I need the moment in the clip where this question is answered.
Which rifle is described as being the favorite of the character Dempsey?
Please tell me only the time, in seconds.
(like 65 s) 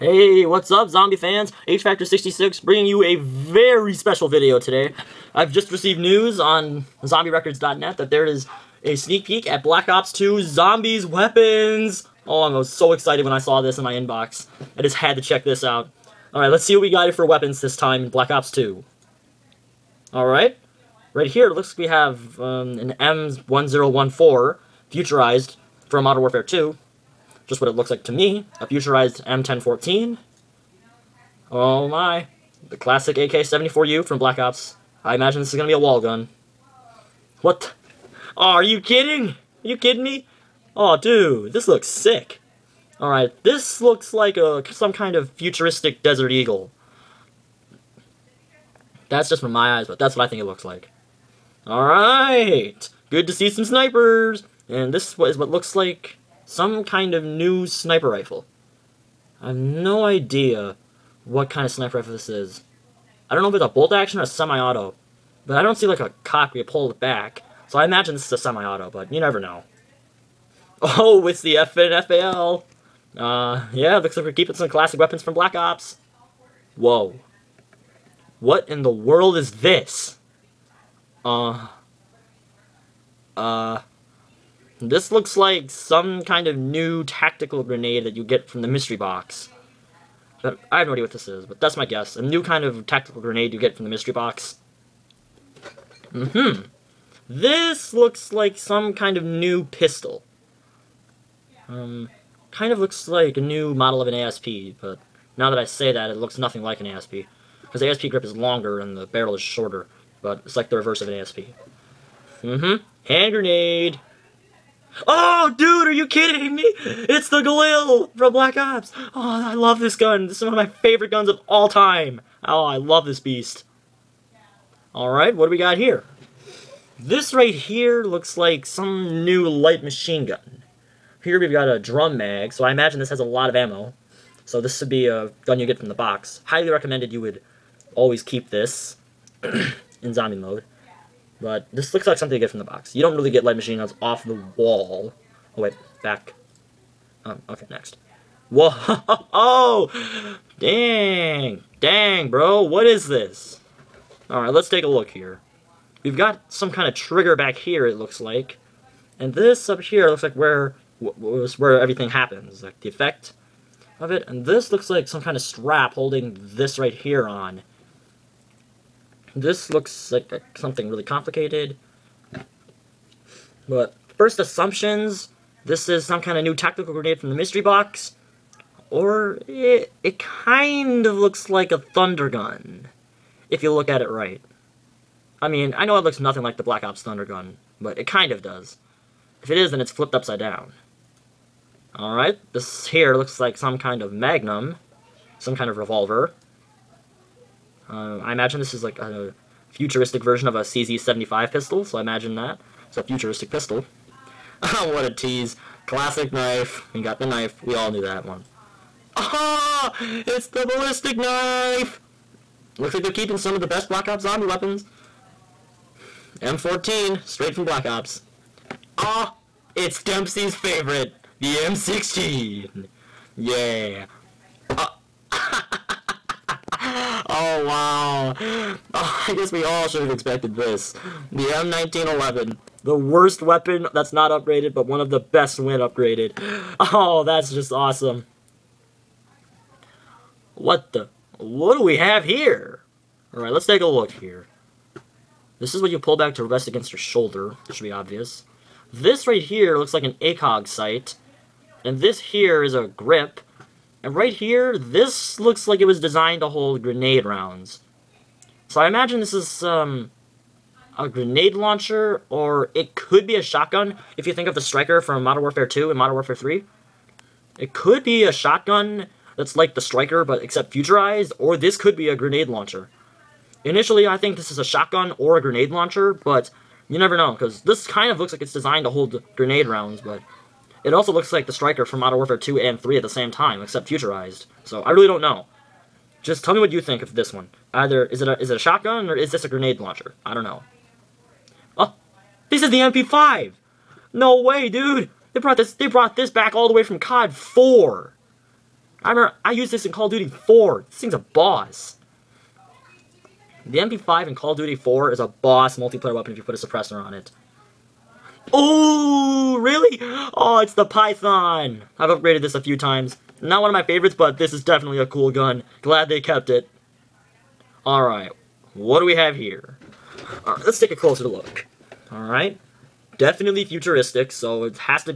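221 s.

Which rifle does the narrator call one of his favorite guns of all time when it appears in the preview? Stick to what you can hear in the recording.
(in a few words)
Galil.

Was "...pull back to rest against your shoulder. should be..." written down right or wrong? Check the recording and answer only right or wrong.
right.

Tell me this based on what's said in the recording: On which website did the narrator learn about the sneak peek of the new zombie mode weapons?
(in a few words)
zombierecords.net.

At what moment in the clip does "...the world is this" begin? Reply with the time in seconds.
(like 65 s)
78 s.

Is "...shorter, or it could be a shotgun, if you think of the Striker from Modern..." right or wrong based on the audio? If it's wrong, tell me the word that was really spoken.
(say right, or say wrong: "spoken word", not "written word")
wrong: "launcher", not "shorter".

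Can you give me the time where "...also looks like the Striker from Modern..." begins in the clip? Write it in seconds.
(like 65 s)
280 s.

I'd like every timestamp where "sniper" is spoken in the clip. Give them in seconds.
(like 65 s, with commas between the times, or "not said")
53 s, 57 s, 61 s.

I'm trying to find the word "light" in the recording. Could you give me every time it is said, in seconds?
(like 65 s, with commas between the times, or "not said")
129 s, 143 s.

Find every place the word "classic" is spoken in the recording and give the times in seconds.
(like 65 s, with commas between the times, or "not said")
32 s, 74 s, 205 s.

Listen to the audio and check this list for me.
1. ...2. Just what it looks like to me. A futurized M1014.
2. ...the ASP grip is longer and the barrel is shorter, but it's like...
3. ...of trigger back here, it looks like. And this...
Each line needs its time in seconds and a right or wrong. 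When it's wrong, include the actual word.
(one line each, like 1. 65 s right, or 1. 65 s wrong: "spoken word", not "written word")
1. 26 s right
2. 107 s right
3. 156 s right.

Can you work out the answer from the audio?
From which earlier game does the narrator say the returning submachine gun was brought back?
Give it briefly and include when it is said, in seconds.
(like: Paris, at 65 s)
Call of Duty 4, at 296 s.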